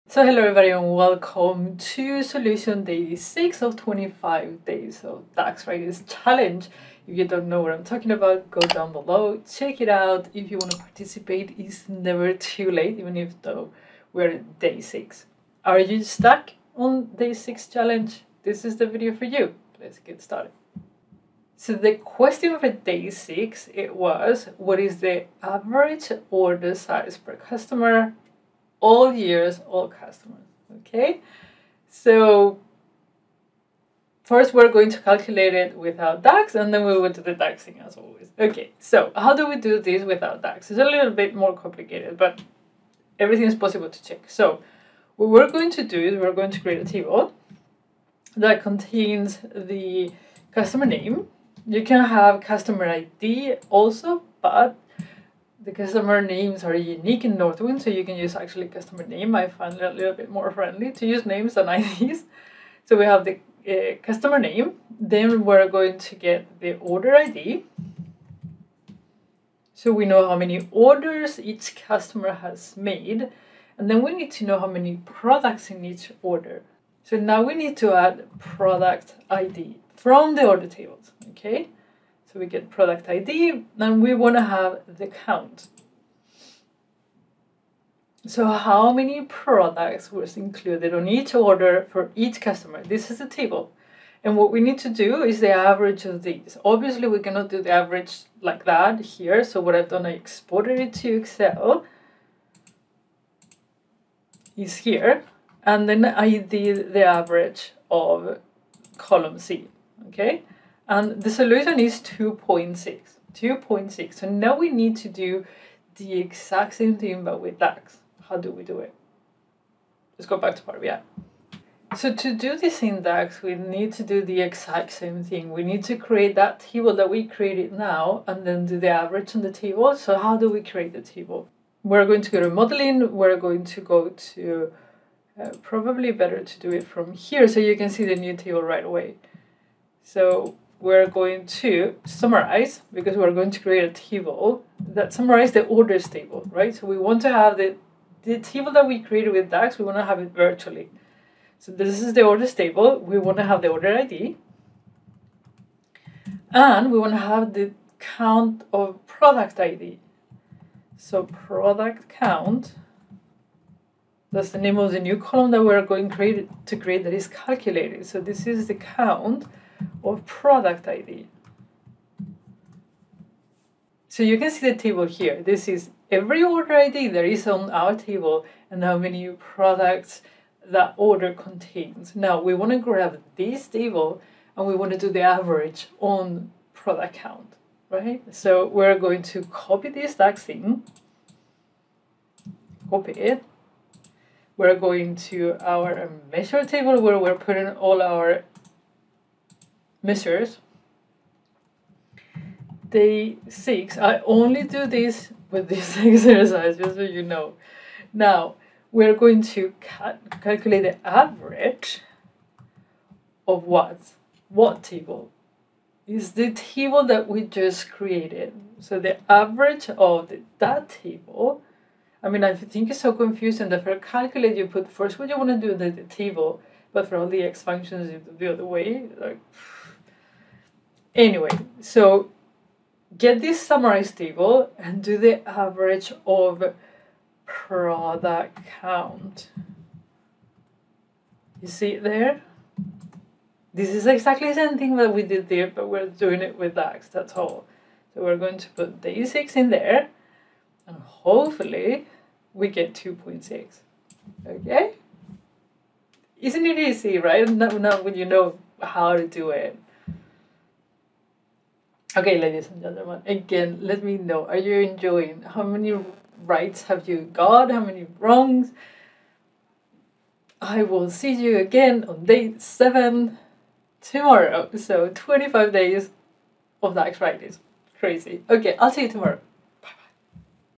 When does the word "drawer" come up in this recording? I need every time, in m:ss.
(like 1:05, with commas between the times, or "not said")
not said.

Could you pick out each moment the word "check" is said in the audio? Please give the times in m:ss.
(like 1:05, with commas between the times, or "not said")
0:09, 0:44.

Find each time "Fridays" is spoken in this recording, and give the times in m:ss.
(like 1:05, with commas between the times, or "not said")
0:05, 4:37.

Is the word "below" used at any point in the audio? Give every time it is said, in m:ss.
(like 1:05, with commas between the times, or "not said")
0:08.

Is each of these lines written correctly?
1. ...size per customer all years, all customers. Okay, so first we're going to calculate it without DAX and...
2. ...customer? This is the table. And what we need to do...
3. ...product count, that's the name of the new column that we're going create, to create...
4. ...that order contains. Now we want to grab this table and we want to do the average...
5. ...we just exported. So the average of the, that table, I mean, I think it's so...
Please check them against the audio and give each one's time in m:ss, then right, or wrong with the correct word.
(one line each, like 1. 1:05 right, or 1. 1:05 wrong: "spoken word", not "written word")
1. 0:26 right
2. 1:32 right
3. 2:41 right
4. 3:00 right
5. 3:37 wrong: "created", not "exported".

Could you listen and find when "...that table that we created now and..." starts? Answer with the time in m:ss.
2:06.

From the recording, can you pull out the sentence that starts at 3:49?
Like, Anyway, so get this summarized table and do the average of product count.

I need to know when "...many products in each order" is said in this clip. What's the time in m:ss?
1:14.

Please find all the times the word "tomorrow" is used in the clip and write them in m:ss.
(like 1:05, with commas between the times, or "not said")
4:34, 4:39.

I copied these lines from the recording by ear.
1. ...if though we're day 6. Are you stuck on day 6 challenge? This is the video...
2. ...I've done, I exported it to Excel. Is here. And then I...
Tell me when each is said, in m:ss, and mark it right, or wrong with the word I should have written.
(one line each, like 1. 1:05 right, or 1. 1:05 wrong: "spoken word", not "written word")
1. 0:13 right
2. 1:39 right.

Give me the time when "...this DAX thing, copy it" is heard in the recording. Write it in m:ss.
3:09.